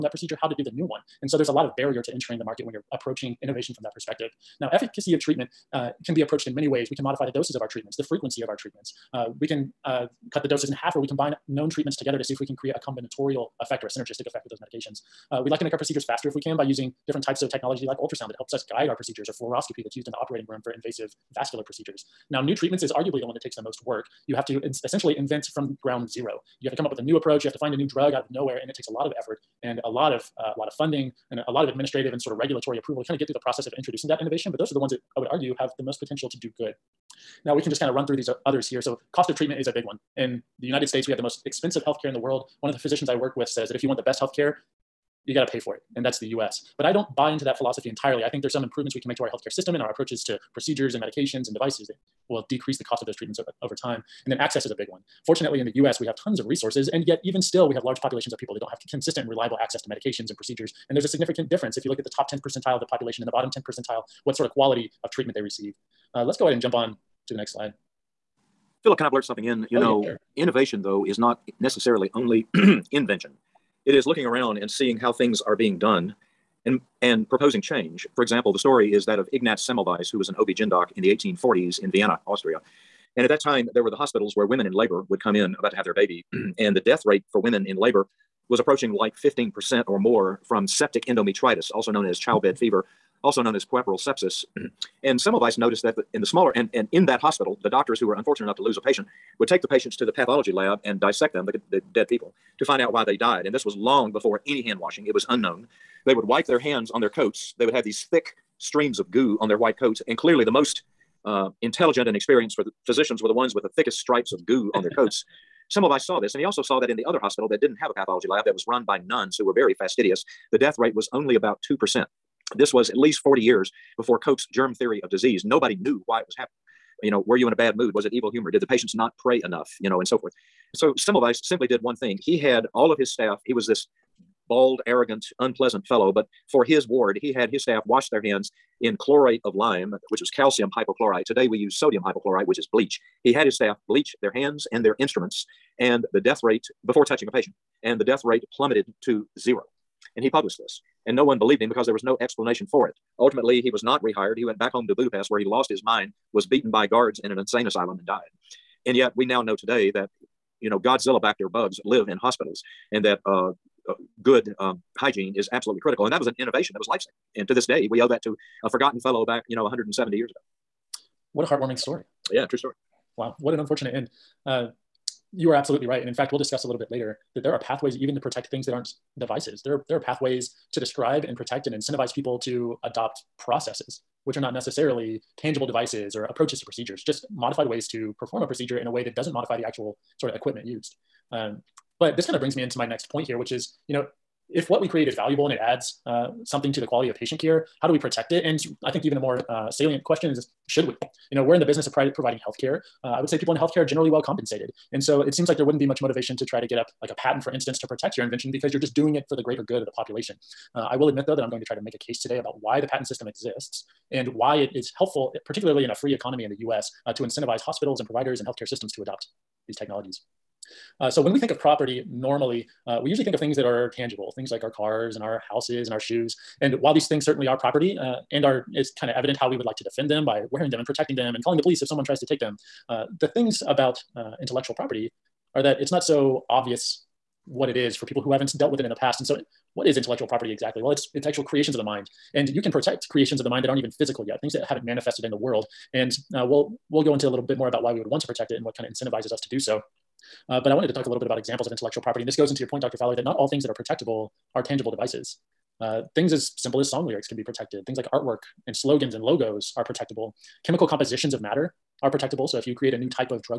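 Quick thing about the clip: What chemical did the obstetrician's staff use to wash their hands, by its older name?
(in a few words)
chlorate of lime.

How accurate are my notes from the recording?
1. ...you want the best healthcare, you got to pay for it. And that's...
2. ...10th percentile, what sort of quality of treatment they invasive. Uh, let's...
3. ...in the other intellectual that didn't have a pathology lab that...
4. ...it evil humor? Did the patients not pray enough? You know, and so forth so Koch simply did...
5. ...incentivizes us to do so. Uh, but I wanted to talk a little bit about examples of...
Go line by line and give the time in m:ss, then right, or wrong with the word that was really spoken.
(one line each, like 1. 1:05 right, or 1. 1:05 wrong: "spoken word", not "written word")
1. 0:43 right
2. 1:03 wrong: "receive", not "invasive"
3. 1:56 wrong: "hospital", not "intellectual"
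4. 2:08 wrong: "Semmelweis", not "Koch"
5. 4:08 right.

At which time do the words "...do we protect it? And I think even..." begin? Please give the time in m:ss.
3:17.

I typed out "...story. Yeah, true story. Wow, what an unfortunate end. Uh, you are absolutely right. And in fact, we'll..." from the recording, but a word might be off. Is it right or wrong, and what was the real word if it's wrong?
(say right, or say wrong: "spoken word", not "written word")
right.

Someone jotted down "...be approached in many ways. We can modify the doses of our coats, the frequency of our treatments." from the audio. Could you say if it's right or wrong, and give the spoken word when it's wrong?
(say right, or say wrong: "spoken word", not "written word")
wrong: "treatments", not "coats".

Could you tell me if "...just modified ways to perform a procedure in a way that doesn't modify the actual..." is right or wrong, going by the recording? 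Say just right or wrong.
right.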